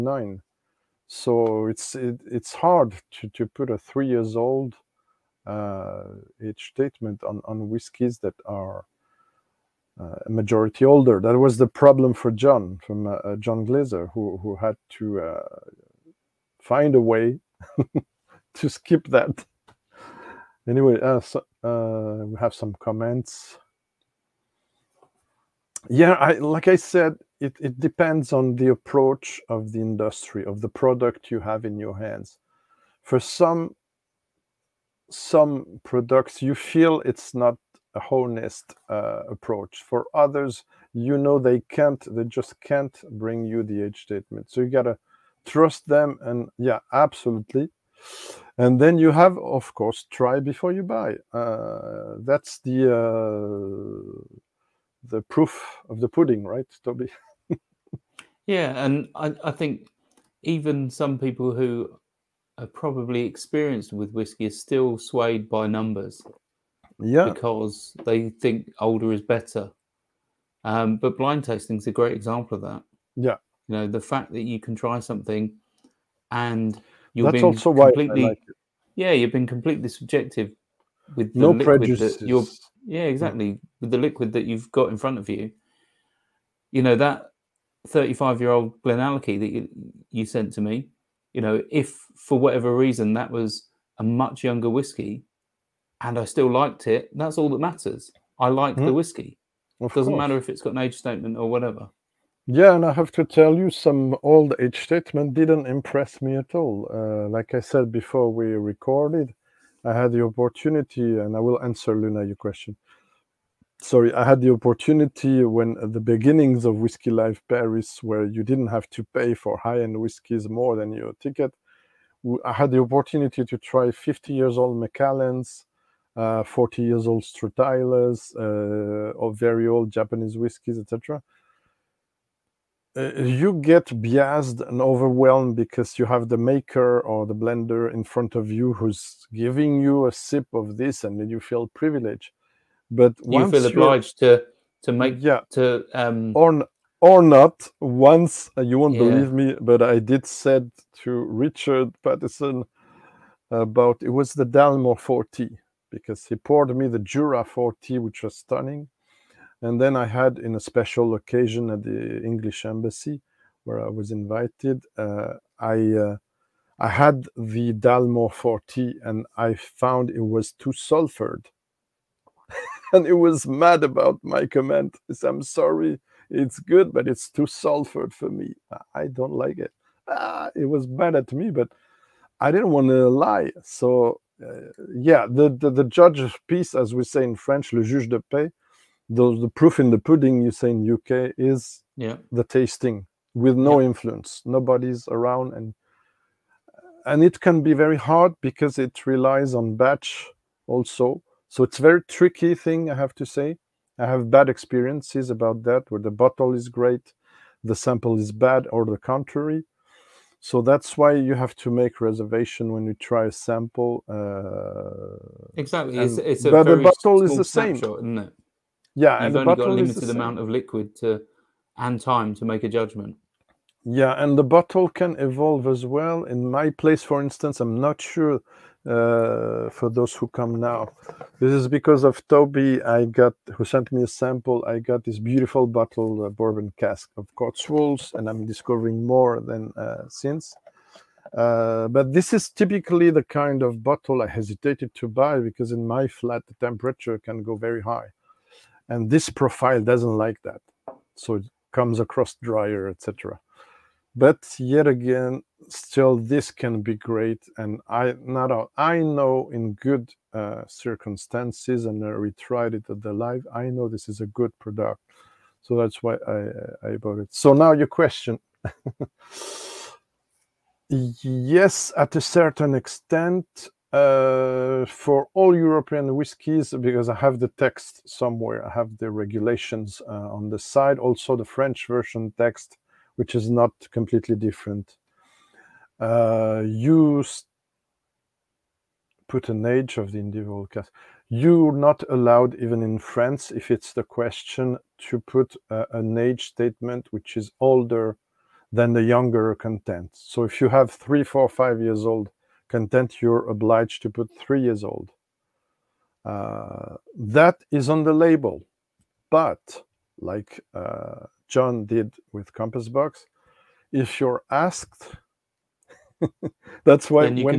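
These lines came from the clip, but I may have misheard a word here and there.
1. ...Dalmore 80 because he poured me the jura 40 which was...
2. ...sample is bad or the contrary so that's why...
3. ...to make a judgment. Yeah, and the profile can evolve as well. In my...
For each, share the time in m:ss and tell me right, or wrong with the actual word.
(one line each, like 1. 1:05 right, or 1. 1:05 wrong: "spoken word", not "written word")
1. 2:34 wrong: "40", not "80"
2. 3:27 right
3. 3:42 wrong: "bottle", not "profile".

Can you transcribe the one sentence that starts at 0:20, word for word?
Anyway, uh, so, uh, we have some comments.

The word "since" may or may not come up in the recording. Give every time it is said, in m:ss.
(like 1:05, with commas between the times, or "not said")
4:00.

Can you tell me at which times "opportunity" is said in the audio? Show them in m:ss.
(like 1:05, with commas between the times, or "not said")
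1:50, 1:54, 2:02.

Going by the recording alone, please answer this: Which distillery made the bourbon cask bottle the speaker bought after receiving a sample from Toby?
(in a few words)
Cotswolds.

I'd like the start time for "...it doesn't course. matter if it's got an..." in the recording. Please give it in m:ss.
1:39.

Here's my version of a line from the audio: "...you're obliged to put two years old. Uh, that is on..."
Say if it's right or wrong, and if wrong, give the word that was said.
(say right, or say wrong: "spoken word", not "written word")
wrong: "three", not "two".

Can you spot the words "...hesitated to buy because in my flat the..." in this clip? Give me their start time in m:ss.
4:04.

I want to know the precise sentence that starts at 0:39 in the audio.
For others, you know they can't, they just can't bring you the edge statement.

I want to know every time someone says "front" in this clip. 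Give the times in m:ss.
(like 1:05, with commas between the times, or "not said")
1:24, 2:18.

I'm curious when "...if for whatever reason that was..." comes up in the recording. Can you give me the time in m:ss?
1:31.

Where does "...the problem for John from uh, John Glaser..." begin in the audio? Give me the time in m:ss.
0:11.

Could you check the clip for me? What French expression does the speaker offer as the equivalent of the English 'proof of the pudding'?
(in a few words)
le juge de paix.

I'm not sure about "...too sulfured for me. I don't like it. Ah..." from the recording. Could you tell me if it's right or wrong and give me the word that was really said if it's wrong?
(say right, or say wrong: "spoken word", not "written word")
right.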